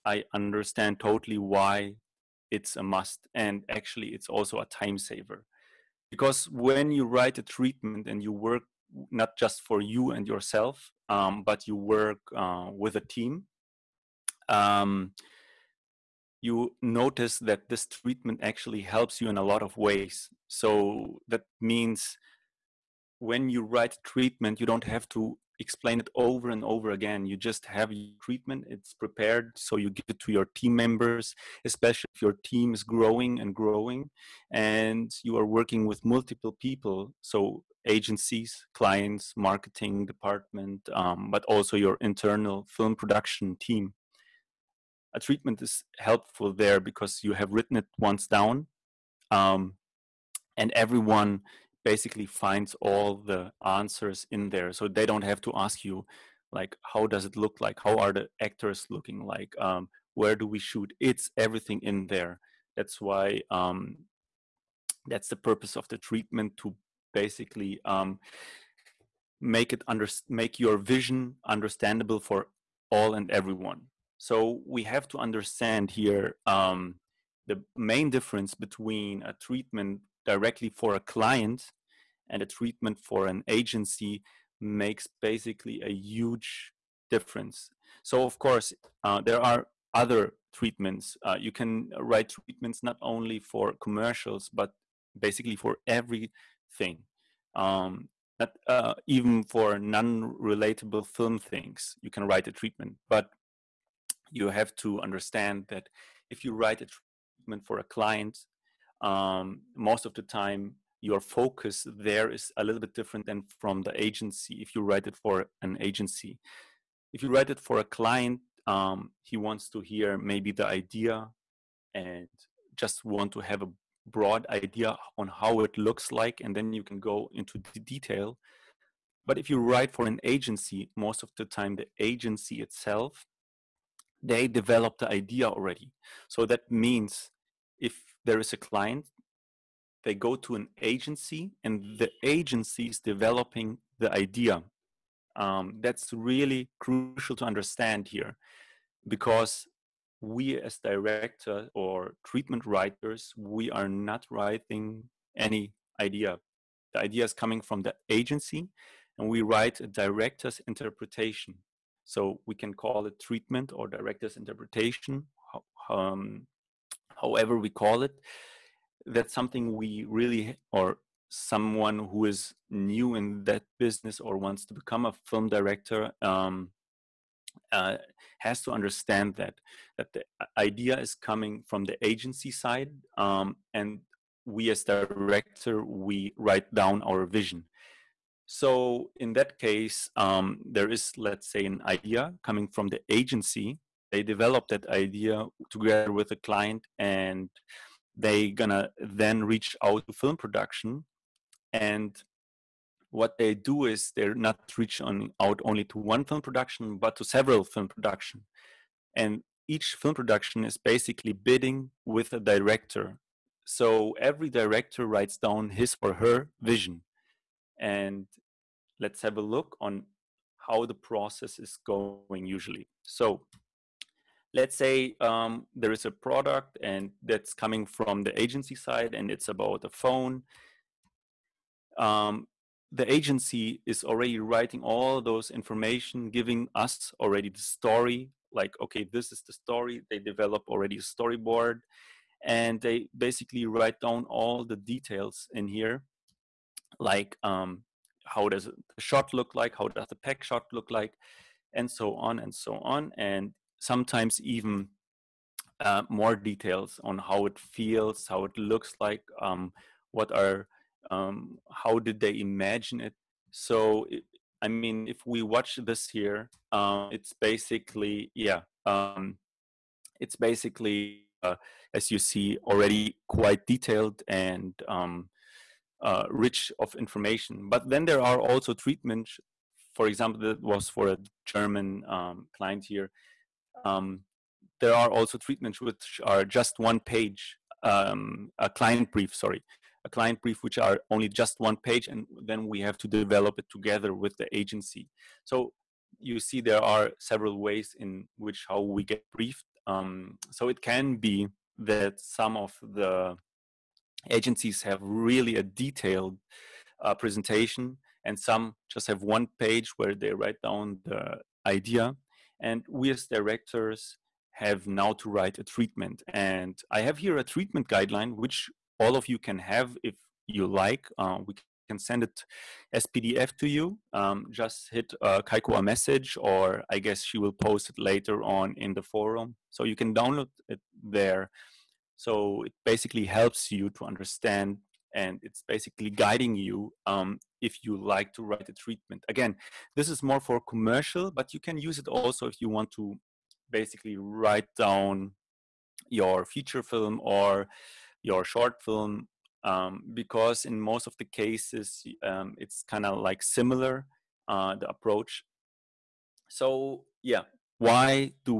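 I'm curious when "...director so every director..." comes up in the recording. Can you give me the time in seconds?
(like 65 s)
212 s.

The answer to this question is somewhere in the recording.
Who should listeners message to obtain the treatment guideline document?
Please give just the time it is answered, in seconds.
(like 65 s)
325 s.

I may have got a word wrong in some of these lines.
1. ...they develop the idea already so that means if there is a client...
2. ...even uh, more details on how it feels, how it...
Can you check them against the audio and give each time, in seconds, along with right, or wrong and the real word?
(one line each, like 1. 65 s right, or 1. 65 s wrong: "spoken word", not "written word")
1. 134 s right
2. 254 s right.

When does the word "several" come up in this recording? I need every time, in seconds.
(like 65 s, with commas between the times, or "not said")
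207 s, 297 s.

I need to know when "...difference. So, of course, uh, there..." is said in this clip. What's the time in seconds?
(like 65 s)
87 s.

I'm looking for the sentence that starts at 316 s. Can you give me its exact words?
And I have here a treatment guideline, which all of you can have if you like.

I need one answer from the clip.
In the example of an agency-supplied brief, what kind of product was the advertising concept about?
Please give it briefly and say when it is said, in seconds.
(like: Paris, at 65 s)
a phone, at 229 s.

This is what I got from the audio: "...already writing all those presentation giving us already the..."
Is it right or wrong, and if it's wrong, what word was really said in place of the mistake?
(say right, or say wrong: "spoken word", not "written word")
wrong: "information", not "presentation".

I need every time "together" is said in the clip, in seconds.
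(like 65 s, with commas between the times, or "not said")
195 s, 293 s.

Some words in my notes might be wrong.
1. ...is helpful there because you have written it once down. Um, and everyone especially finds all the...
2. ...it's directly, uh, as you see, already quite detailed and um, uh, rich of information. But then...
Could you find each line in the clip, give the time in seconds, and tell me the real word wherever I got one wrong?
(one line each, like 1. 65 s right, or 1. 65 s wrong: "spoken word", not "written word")
1. 45 s wrong: "basically", not "especially"
2. 270 s wrong: "basically", not "directly".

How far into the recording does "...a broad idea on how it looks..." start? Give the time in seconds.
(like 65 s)
123 s.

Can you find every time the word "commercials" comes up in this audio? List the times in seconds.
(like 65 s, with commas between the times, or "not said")
93 s, 340 s.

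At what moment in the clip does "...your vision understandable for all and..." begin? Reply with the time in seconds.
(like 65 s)
70 s.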